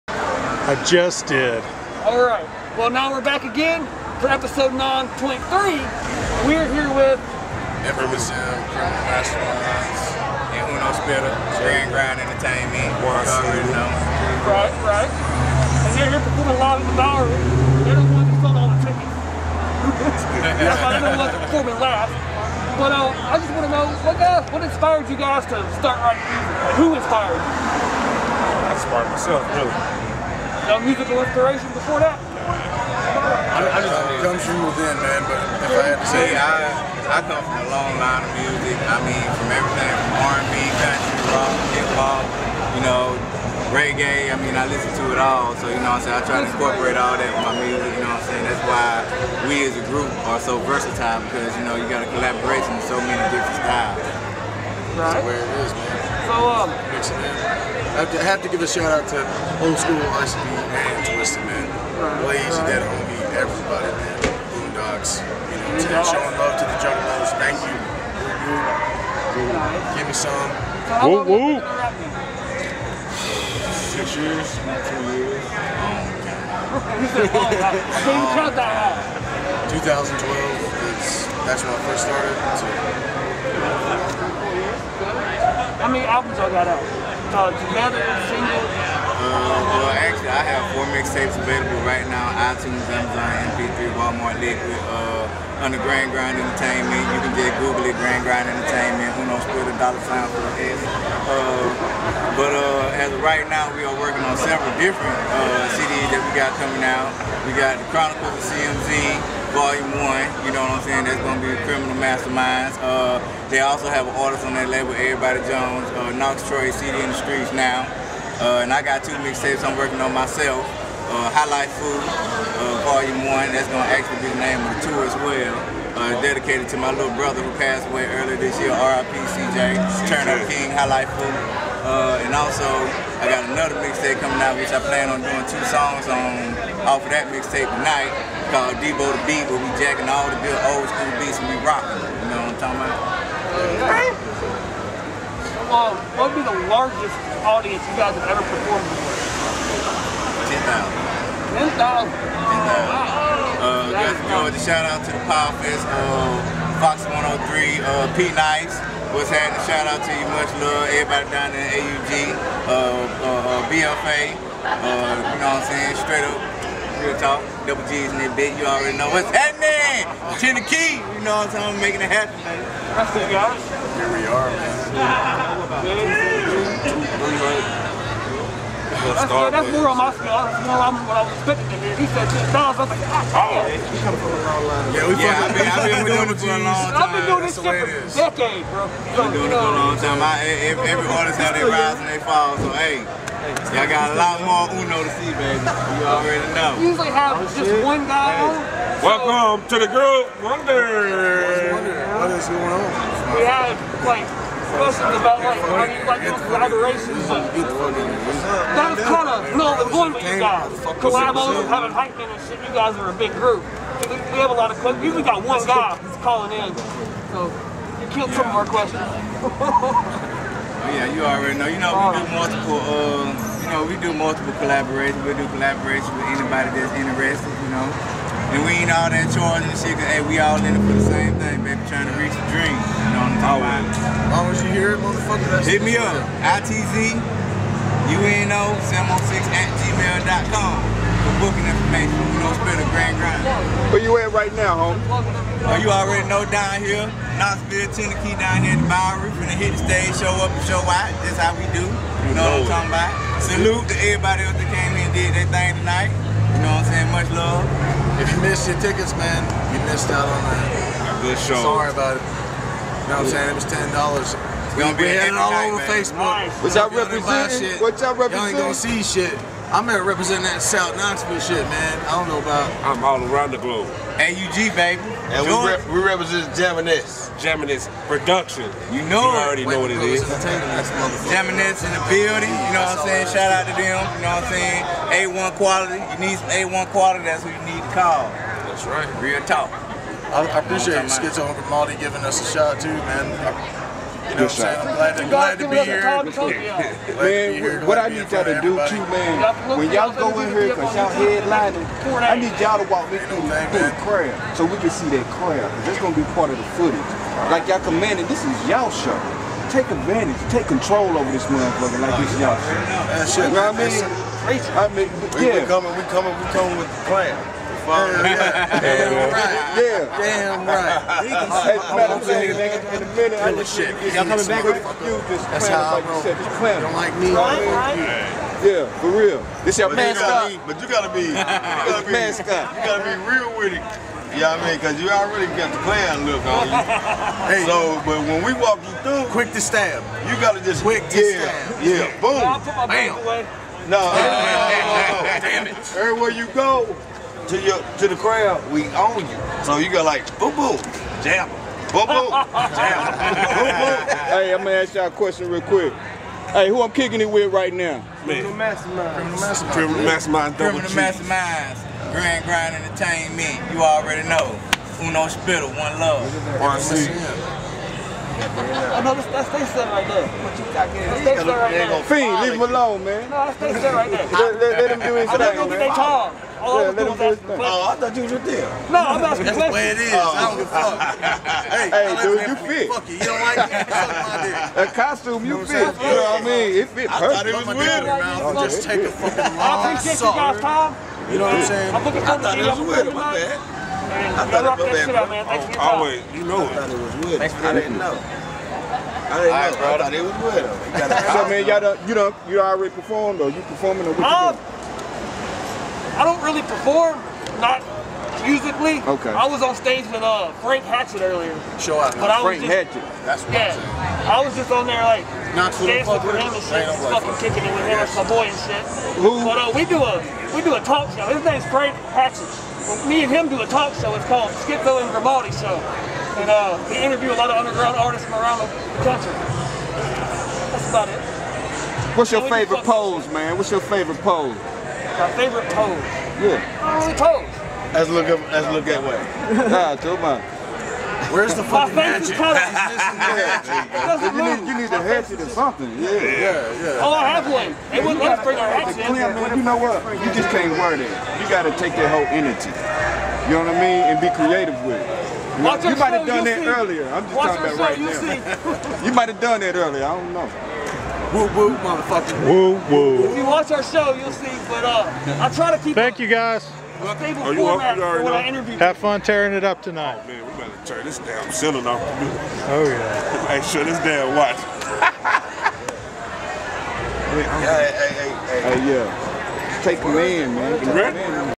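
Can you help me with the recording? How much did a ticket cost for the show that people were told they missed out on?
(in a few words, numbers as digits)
$10.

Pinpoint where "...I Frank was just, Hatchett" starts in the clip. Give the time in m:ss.
6:52.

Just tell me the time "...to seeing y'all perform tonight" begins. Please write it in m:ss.
6:32.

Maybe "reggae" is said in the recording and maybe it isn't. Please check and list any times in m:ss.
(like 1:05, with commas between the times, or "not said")
0:43.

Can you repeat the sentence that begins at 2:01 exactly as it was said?
Uh, Highlight Food, uh, Volume 1, that's going to actually be the name of the tour as well.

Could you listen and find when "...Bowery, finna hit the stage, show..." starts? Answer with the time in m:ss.
4:08.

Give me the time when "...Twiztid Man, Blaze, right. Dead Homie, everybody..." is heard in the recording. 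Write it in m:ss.
1:01.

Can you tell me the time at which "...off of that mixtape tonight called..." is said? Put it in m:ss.
2:16.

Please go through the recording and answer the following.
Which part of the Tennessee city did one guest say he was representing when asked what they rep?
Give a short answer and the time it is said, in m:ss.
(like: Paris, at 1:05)
South Knoxville, at 4:30.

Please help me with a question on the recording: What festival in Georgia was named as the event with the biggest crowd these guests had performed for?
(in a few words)
Power Fest.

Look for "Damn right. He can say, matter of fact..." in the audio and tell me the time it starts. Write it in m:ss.
5:20.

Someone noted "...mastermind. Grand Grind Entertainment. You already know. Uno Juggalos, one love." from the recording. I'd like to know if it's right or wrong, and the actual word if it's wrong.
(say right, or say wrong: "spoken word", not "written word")
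wrong: "Spitta", not "Juggalos".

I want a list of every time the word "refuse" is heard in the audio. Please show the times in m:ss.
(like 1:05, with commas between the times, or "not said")
not said.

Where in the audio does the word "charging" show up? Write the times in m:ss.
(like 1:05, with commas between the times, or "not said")
3:49.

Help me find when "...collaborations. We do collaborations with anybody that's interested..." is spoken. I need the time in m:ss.
3:44.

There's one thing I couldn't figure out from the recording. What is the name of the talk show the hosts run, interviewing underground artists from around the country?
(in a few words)
Skitzo and Grimaldi Show.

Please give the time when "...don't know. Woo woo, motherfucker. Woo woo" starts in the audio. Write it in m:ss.
7:40.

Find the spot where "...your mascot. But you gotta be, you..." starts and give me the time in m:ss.
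5:29.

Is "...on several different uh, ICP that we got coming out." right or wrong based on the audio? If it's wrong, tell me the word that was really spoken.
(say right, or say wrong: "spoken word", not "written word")
wrong: "CDs", not "ICP".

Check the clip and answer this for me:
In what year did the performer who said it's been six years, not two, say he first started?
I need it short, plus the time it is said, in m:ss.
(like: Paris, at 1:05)
2012, at 1:17.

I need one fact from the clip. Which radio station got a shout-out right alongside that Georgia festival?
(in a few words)
Fox 103.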